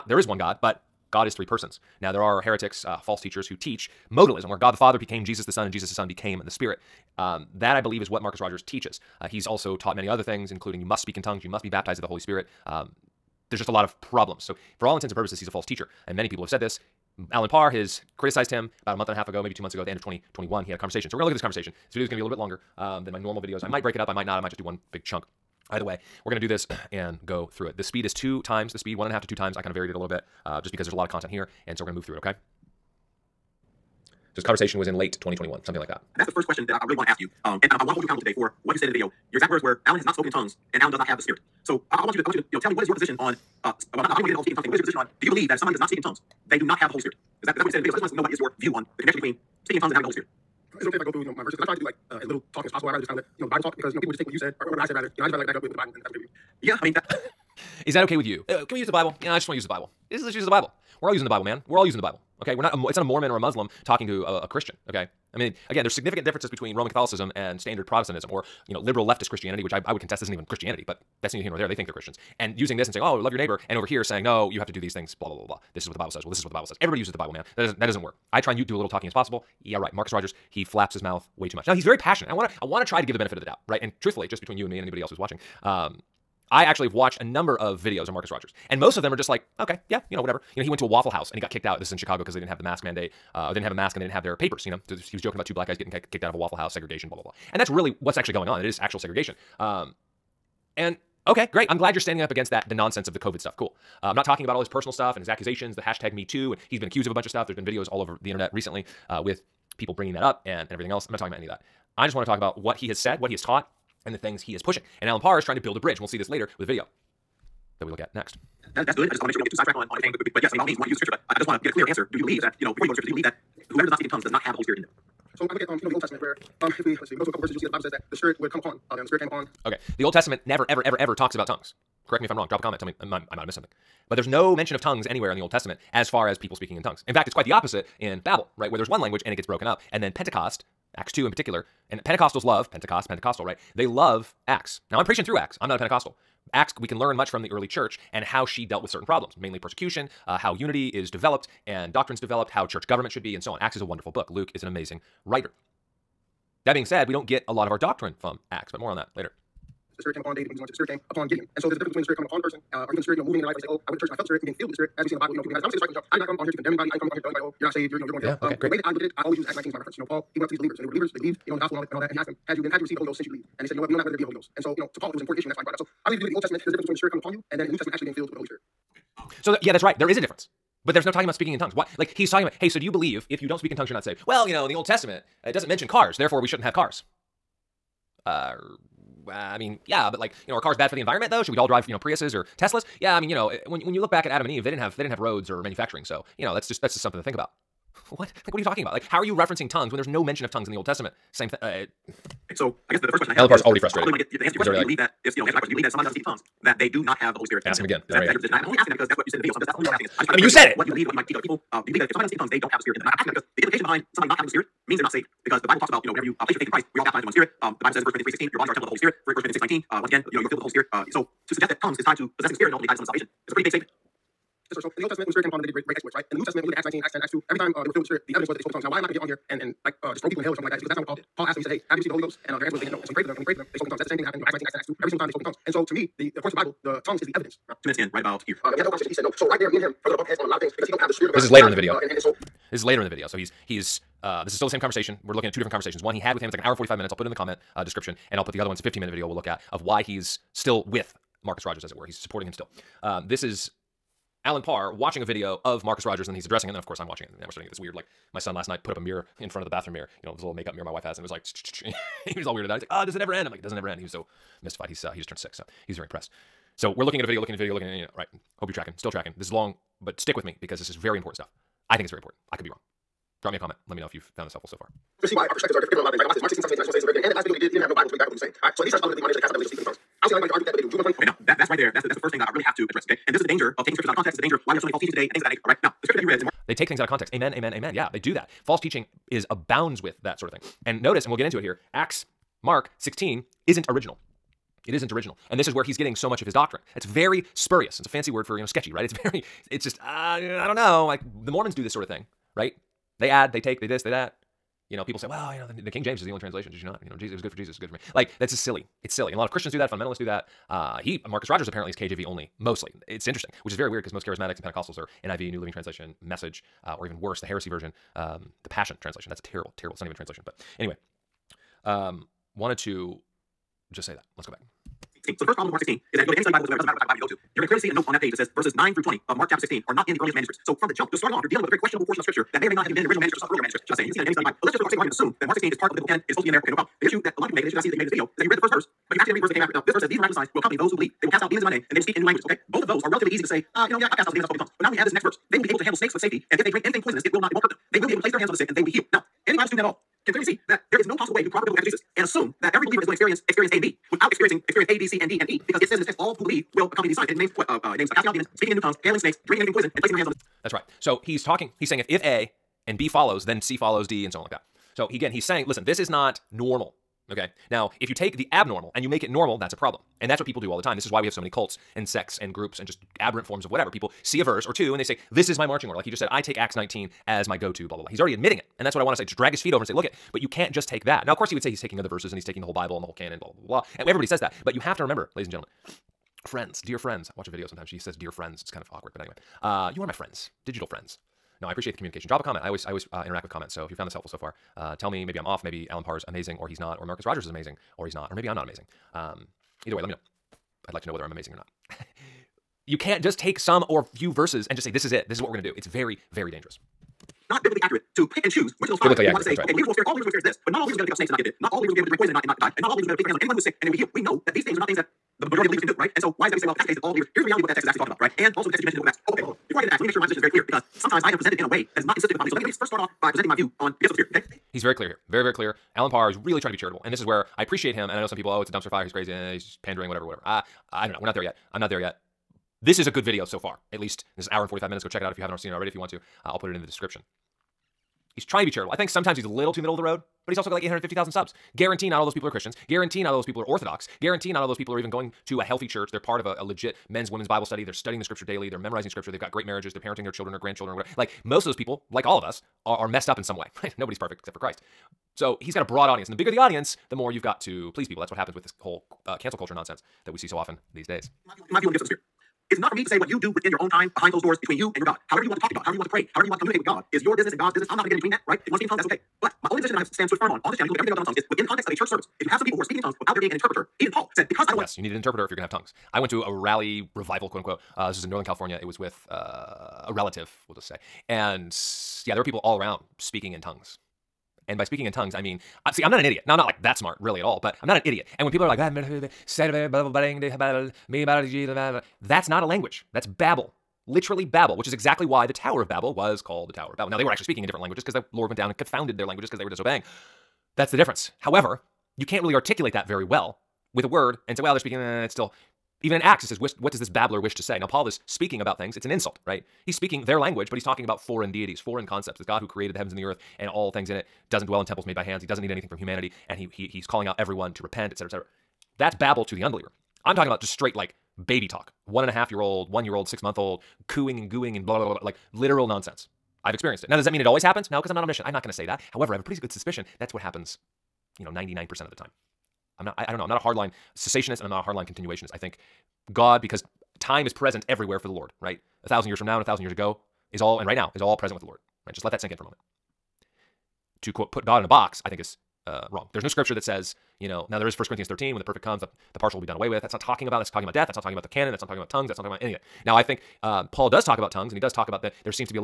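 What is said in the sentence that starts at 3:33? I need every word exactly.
And I, am asking that because the implication behind somebody not having the Spirit means they're not saved.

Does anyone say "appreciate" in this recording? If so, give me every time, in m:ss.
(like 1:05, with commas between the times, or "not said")
6:31, 7:07.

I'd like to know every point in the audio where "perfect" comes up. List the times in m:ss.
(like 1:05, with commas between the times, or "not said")
7:34, 9:08.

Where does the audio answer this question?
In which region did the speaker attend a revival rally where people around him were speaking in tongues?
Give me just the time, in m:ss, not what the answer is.
7:58.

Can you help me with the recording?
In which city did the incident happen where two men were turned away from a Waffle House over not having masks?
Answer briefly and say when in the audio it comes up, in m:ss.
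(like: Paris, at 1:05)
Chicago, at 1:31.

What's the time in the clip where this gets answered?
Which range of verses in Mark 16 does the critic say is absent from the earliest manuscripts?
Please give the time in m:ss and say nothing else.
5:28.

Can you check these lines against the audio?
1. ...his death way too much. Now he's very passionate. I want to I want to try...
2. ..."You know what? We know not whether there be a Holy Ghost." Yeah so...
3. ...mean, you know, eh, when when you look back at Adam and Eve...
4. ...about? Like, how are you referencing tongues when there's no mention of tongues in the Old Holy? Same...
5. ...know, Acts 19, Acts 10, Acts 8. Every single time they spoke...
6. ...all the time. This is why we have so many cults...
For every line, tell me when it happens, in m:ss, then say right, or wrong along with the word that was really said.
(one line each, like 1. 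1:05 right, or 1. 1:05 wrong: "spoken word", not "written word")
1. 1:20 wrong: "mouth", not "death"
2. 2:53 wrong: "And", not "Yeah"
3. 3:13 right
4. 3:18 wrong: "Testament", not "Holy"
5. 3:54 wrong: "2", not "8"
6. 6:10 right.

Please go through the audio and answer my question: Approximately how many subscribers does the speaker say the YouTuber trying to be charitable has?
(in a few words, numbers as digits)
850,000.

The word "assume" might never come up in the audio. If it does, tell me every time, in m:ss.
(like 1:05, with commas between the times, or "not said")
5:35, 5:52.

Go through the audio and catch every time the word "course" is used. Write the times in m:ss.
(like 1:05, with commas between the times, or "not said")
4:16, 6:21.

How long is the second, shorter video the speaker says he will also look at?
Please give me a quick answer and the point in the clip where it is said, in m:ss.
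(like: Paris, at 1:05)
15 minutes, at 4:08.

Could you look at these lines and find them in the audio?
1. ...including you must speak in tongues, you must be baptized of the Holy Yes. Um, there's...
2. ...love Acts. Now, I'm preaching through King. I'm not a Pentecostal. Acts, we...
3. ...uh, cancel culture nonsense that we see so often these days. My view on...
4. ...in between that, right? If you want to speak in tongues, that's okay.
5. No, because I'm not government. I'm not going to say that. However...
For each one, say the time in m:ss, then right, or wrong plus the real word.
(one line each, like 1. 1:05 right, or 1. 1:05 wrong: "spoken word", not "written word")
1. 0:10 wrong: "Spirit", not "Yes"
2. 2:23 wrong: "Acts", not "King"
3. 7:39 right
4. 7:48 right
5. 8:47 wrong: "omniscient", not "government".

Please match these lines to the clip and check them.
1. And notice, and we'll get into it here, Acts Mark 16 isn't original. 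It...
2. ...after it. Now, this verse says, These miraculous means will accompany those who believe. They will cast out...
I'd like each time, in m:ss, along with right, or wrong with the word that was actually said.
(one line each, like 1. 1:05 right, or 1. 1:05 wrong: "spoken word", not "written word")
1. 4:50 right
2. 5:39 wrong: "signs", not "means".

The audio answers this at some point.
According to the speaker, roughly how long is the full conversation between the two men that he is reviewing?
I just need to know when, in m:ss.
4:06.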